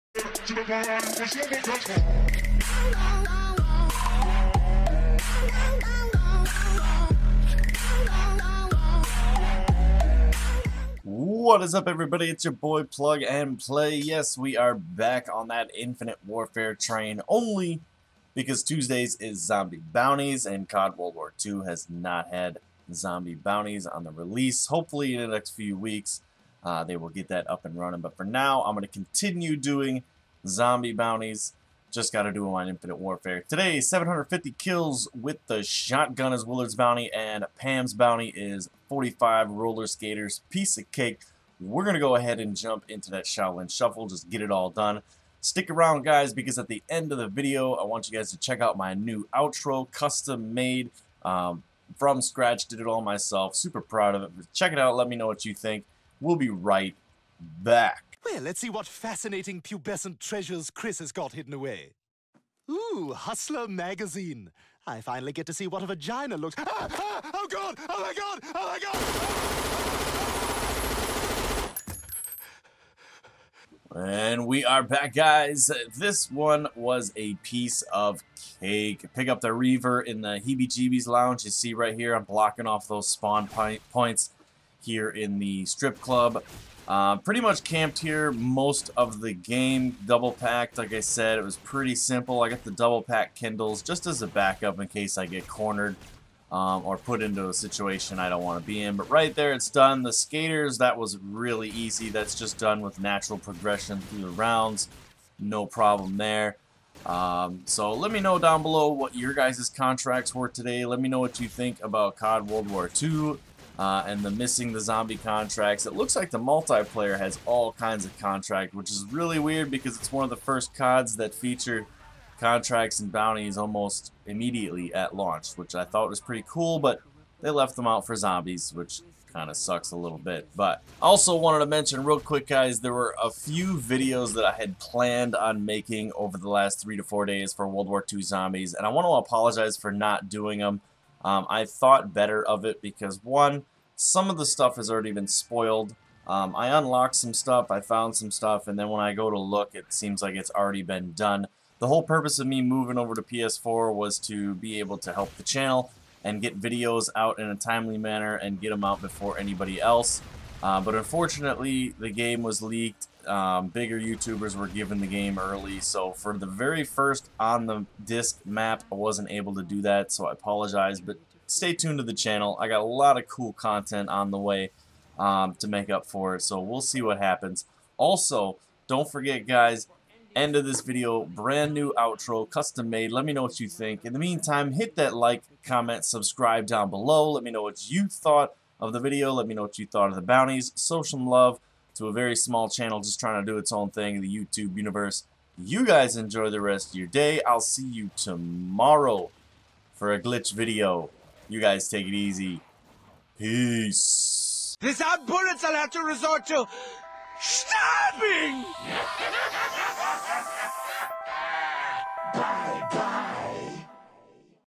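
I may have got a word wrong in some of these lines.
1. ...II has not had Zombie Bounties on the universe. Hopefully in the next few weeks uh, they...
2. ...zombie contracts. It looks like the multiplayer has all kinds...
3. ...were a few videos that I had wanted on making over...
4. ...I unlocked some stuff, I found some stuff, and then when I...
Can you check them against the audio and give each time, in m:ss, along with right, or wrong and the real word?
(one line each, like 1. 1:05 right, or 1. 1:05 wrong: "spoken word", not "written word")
1. 0:21 wrong: "release", not "universe"
2. 1:54 right
3. 2:12 wrong: "planned", not "wanted"
4. 2:26 right.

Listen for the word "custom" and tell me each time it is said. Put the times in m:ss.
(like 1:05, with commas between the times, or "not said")
0:49, 3:02.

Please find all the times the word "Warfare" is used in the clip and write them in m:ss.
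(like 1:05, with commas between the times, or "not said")
0:16, 0:32.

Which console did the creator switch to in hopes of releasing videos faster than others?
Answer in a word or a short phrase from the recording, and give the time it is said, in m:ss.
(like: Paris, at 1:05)
PS4, at 2:33.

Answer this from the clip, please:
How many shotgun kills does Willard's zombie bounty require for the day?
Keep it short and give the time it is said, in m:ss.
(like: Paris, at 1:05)
750, at 0:33.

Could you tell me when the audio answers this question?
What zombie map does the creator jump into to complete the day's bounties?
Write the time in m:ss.
0:43.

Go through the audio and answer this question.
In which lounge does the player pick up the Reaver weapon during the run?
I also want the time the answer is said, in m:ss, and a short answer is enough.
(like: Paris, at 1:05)
Heebie-Jeebies Lounge, at 1:20.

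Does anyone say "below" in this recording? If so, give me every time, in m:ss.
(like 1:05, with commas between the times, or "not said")
1:48, 3:06.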